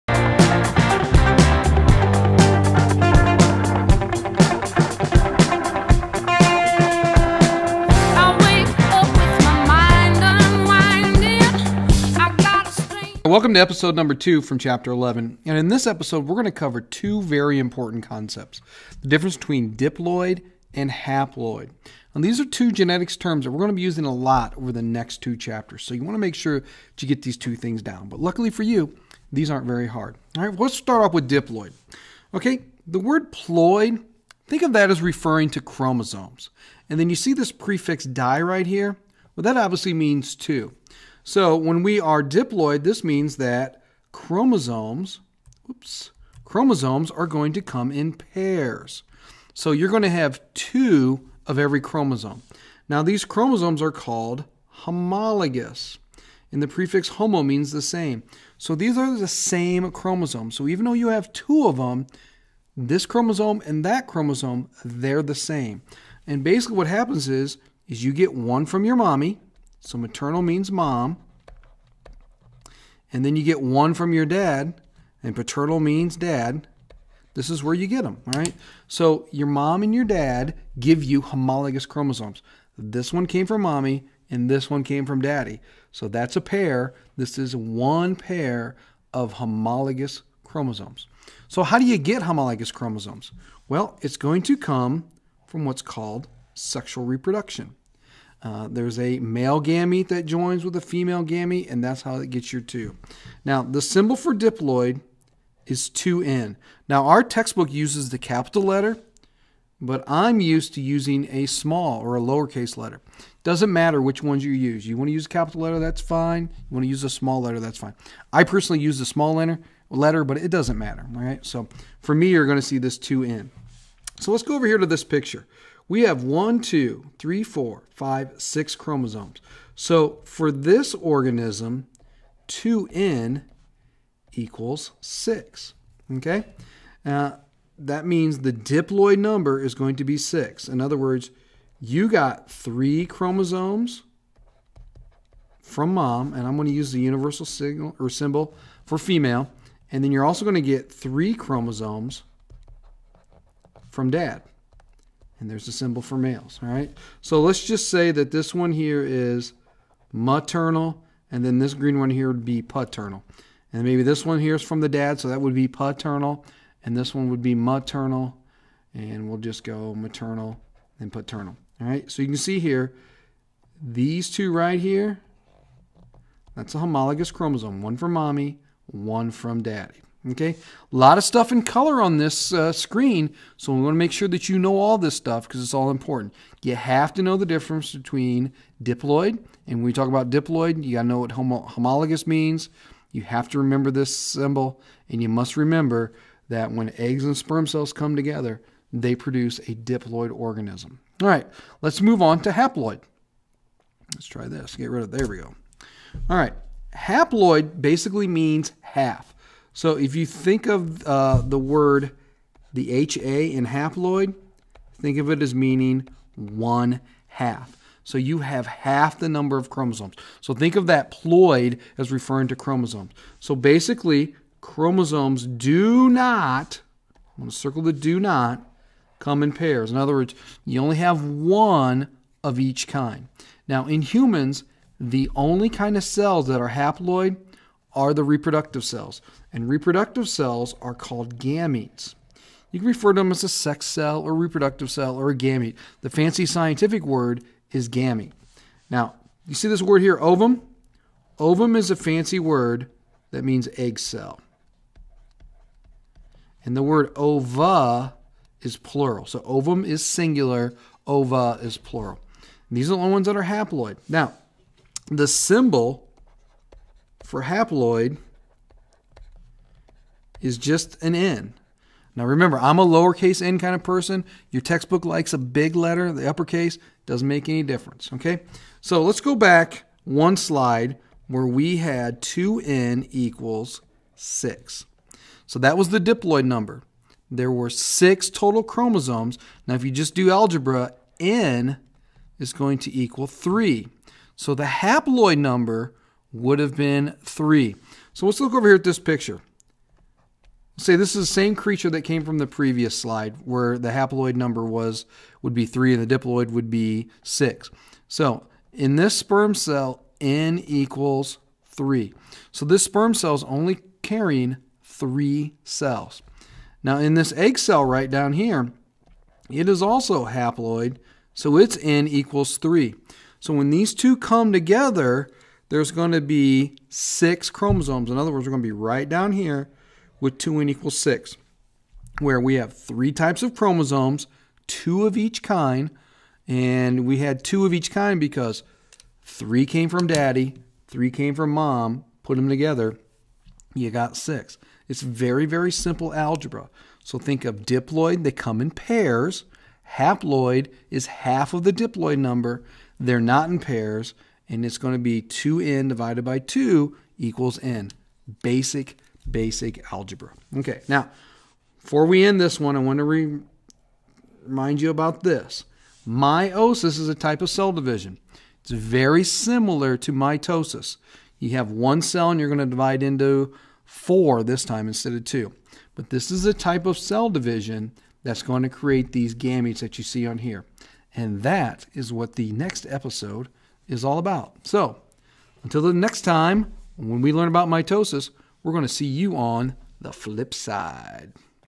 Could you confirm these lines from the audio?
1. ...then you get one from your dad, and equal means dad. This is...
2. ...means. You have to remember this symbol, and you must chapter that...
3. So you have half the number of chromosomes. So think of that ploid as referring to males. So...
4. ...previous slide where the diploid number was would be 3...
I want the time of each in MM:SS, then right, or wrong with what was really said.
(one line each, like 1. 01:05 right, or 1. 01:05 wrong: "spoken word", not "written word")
1. 01:13 wrong: "paternal", not "equal"
2. 03:12 wrong: "remember", not "chapter"
3. 03:38 wrong: "chromosomes", not "males"
4. 05:02 wrong: "haploid", not "diploid".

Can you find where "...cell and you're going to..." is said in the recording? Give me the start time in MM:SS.
06:12.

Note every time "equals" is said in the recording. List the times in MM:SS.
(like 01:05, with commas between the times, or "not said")
02:14, 04:43, 04:52, 05:10, 05:22, 05:30, 05:57.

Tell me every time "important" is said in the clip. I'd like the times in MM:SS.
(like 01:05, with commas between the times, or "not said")
00:17, 03:05.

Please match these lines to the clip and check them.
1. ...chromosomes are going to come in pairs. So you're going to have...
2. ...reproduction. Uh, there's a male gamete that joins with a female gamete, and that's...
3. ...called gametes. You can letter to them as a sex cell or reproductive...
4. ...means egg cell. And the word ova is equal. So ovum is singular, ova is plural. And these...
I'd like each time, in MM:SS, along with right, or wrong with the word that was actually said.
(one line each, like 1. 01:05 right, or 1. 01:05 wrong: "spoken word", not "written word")
1. 00:46 right
2. 01:37 right
3. 04:00 wrong: "refer", not "letter"
4. 04:13 wrong: "plural", not "equal".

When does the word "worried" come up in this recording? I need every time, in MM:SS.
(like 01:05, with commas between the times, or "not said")
not said.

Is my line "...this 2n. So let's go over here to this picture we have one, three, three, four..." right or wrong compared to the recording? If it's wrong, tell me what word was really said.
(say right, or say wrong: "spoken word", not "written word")
wrong: "two", not "three".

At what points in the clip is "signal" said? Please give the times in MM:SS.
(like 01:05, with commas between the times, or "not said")
02:27.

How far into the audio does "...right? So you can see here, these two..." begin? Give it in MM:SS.
02:51.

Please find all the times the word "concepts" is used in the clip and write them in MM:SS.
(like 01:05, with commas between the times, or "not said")
00:18.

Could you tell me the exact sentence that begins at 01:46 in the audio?
Now, our textbook uses the capital letter, but I'm used to using a small or a lowercase letter.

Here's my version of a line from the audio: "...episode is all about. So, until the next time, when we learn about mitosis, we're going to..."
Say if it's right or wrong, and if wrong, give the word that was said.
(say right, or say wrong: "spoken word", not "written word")
right.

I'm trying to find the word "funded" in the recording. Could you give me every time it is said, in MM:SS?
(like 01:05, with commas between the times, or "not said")
not said.